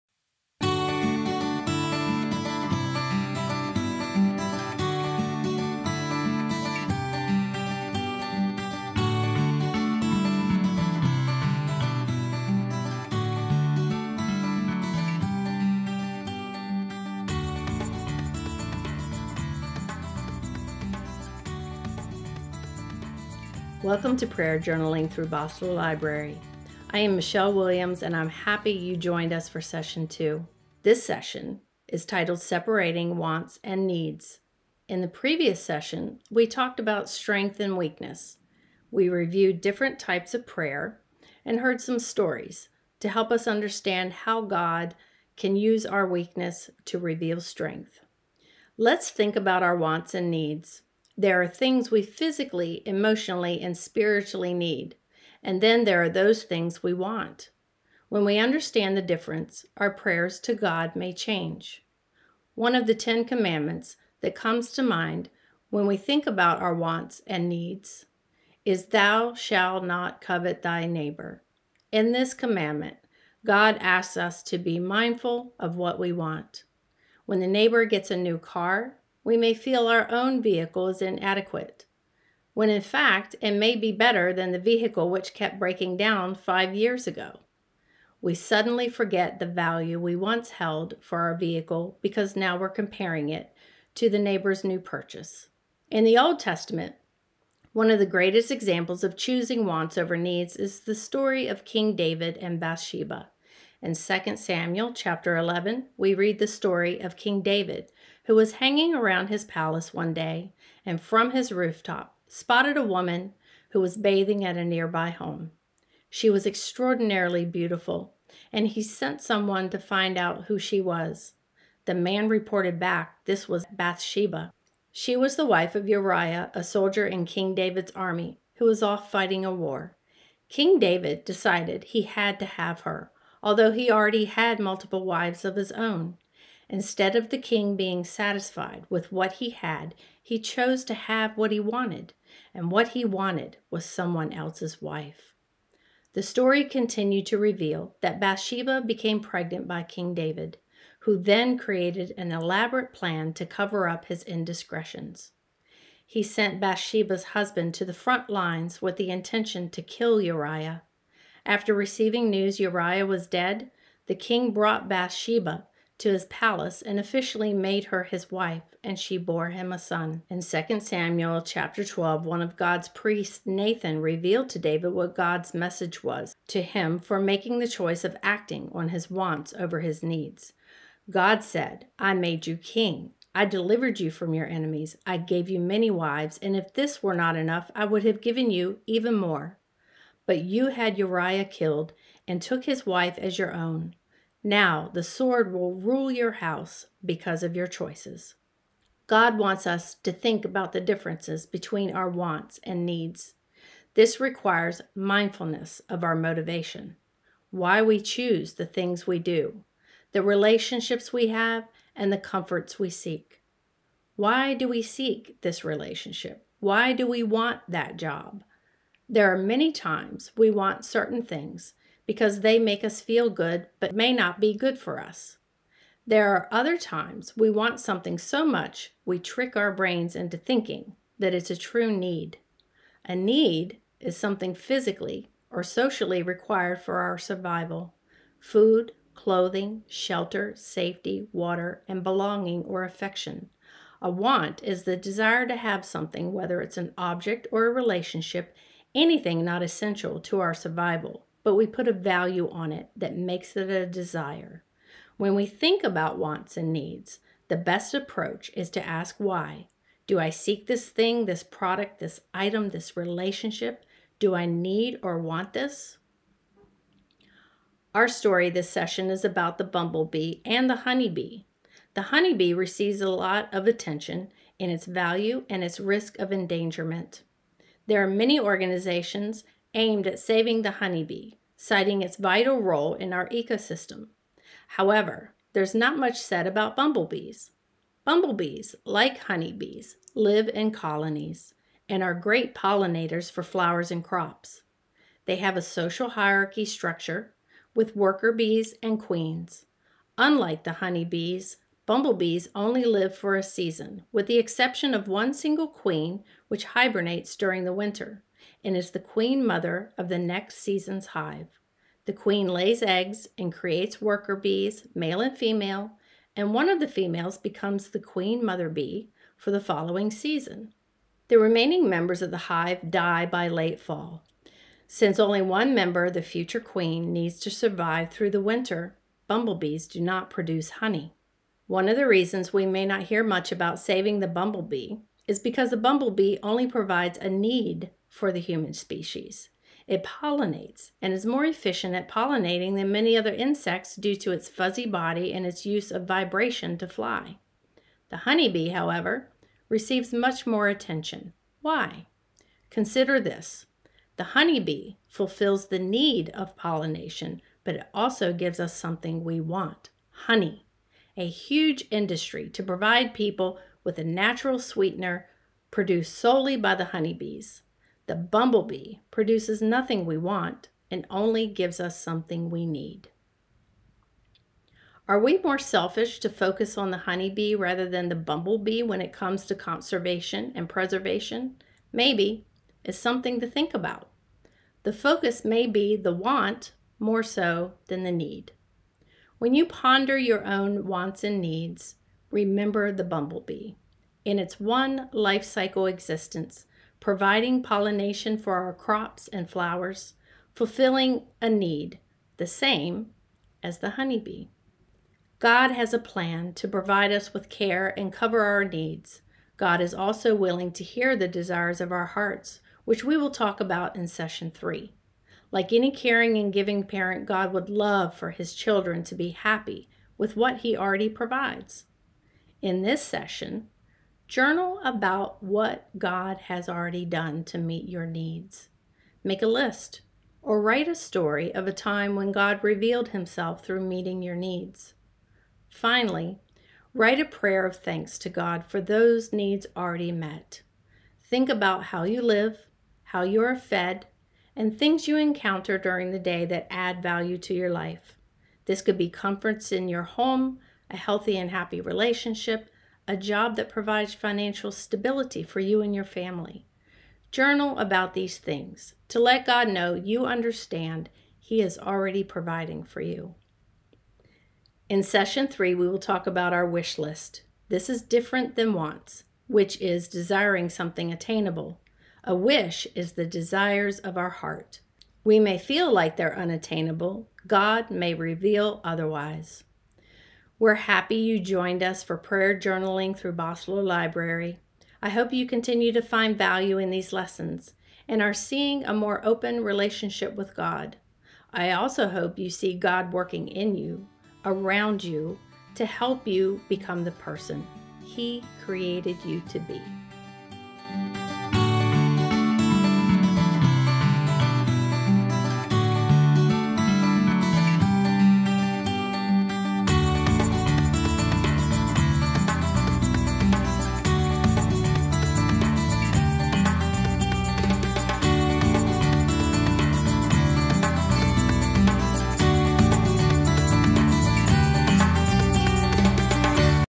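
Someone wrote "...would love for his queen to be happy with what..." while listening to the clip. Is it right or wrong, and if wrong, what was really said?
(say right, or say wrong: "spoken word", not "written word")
wrong: "children", not "queen".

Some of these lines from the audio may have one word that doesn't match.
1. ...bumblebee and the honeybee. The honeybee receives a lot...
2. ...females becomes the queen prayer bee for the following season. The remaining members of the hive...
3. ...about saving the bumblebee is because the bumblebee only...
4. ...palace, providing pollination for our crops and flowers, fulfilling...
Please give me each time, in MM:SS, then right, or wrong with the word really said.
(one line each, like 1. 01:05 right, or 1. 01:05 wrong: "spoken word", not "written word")
1. 04:29 right
2. 05:16 wrong: "mother", not "prayer"
3. 05:33 right
4. 06:35 wrong: "existence", not "palace".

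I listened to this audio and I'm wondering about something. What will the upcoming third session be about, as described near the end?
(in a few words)
our wish list.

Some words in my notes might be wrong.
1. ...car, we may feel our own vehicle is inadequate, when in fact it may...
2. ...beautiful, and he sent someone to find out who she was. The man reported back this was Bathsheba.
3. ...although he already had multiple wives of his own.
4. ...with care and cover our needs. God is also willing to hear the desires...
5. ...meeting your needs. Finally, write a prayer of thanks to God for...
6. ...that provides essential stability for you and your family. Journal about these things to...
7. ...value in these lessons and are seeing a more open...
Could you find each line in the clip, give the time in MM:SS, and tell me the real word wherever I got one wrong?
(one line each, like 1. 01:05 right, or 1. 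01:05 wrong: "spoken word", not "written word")
1. 01:18 right
2. 01:57 right
3. 02:13 right
4. 06:47 right
5. 07:13 right
6. 07:33 wrong: "financial", not "essential"
7. 08:06 right.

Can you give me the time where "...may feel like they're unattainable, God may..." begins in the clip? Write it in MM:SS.
07:55.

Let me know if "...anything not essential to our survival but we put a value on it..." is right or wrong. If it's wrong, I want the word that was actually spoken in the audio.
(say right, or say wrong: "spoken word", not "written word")
right.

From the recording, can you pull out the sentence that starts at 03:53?
A need is something physically or socially required for our survival food, clothing, shelter, safety, water, and belonging or affection.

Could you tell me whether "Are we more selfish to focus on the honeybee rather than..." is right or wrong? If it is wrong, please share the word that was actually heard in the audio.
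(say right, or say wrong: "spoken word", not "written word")
right.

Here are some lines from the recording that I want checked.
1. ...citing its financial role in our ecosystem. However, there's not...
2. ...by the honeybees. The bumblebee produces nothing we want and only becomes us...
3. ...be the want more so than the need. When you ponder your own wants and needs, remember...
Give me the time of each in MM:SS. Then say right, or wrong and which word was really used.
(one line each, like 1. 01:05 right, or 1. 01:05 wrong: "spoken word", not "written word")
1. 04:41 wrong: "vital", not "financial"
2. 06:06 wrong: "gives", not "becomes"
3. 06:25 right.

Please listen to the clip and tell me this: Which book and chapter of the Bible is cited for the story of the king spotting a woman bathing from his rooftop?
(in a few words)
2 Samuel chapter 11.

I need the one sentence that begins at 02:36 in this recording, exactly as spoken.
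He sent Bathsheba's husband to the front lines with the intention to kill Uriah.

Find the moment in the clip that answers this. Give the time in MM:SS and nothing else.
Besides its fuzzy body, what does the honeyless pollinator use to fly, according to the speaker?
05:46.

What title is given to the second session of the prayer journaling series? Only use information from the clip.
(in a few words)
Separating Wants and Needs.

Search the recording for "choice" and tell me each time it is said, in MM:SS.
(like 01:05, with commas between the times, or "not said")
02:57, 03:17.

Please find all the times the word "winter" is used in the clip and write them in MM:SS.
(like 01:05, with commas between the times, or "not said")
05:07, 05:28.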